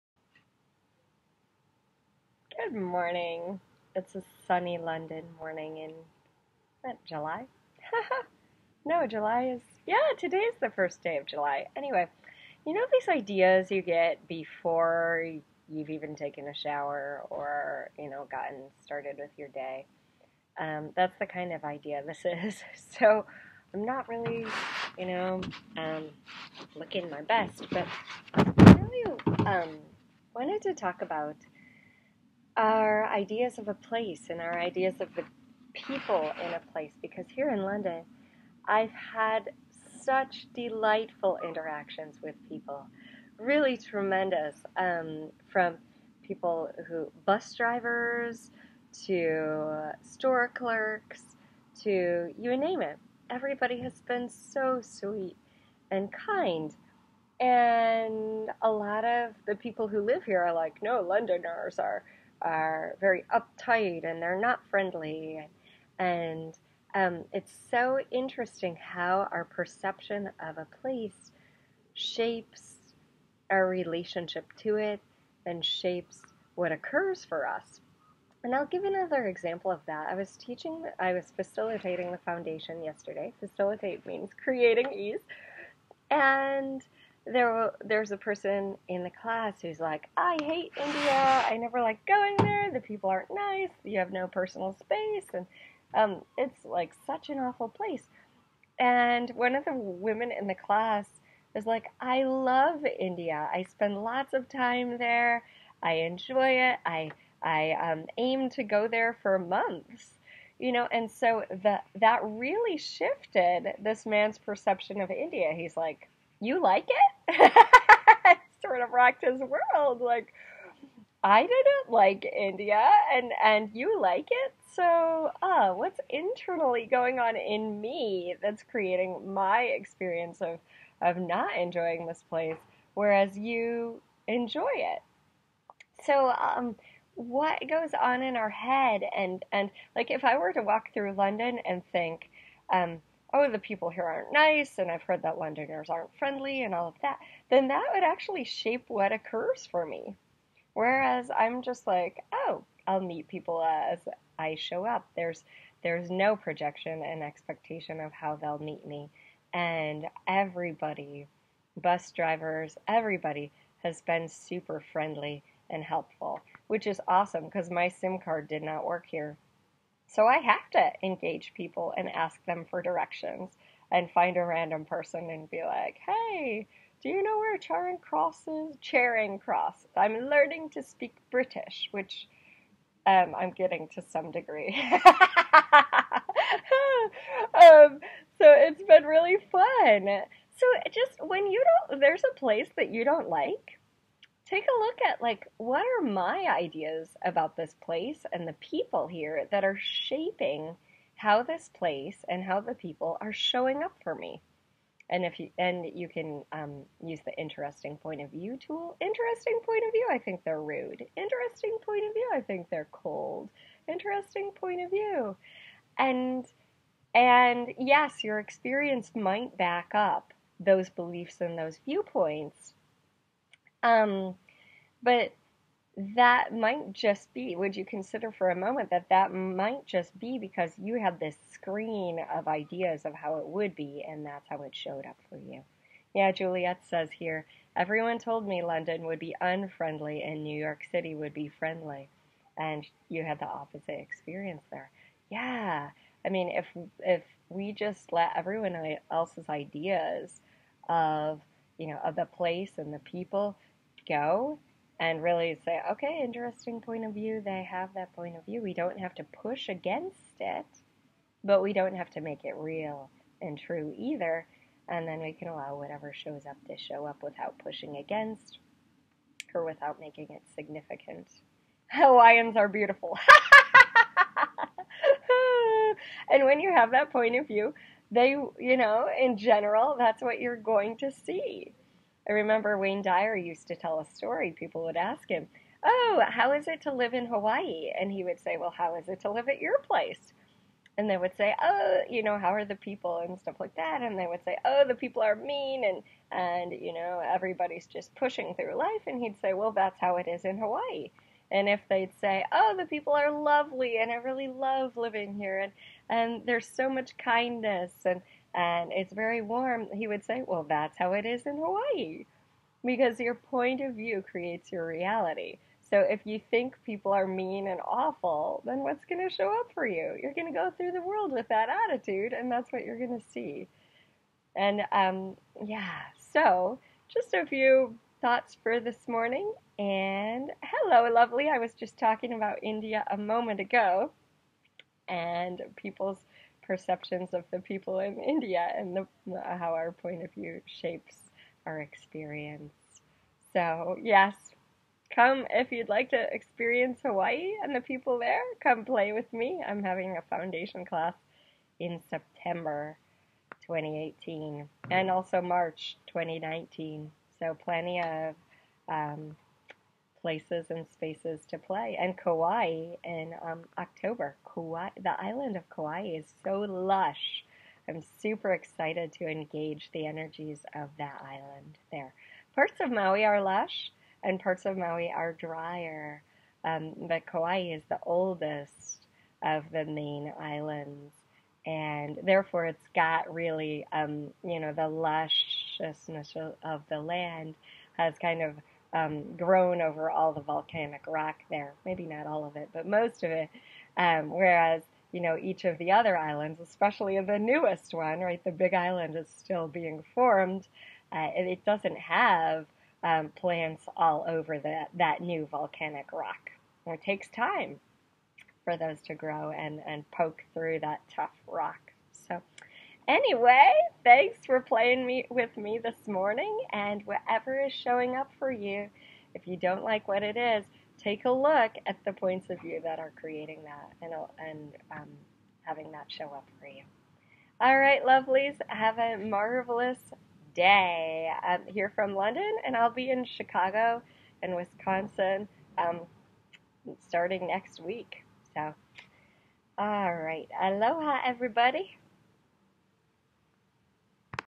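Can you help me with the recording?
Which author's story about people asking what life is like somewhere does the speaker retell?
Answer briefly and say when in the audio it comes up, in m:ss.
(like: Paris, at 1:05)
Wayne Dyer, at 4:42.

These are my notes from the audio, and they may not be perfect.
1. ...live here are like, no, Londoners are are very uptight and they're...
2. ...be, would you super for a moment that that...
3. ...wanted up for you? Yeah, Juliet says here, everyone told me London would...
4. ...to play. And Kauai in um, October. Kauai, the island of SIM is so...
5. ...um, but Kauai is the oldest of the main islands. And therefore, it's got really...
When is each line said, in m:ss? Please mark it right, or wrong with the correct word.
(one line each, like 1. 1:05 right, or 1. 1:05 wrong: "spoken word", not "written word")
1. 1:00 right
2. 3:47 wrong: "consider", not "super"
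3. 3:54 wrong: "showed", not "wanted"
4. 6:01 wrong: "Kauai", not "SIM"
5. 6:16 right.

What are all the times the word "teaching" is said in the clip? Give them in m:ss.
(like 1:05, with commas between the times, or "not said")
1:20.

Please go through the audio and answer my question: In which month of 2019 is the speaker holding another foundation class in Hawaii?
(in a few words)
March.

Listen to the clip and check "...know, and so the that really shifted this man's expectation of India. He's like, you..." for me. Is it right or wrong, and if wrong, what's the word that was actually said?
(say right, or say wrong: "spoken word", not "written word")
wrong: "perception", not "expectation".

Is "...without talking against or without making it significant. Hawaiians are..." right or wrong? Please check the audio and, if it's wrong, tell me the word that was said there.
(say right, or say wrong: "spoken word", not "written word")
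wrong: "pushing", not "talking".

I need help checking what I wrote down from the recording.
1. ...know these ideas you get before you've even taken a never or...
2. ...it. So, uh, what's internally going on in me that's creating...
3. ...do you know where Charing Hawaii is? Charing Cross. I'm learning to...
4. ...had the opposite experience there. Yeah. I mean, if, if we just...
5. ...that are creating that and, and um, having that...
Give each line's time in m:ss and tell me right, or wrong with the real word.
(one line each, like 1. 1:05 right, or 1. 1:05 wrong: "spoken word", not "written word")
1. 0:12 wrong: "shower", not "never"
2. 2:04 right
3. 2:57 wrong: "Cross", not "Hawaii"
4. 4:03 right
5. 7:02 right.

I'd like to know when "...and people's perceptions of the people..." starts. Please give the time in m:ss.
5:35.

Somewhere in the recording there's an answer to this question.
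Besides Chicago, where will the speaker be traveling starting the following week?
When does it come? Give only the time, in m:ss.
7:14.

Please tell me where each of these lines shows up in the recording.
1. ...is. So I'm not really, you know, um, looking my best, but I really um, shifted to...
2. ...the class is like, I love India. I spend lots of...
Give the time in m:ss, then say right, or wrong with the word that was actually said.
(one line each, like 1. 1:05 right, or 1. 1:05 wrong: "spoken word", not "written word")
1. 0:22 wrong: "wanted", not "shifted"
2. 1:40 right.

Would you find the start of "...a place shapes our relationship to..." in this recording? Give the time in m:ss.
1:10.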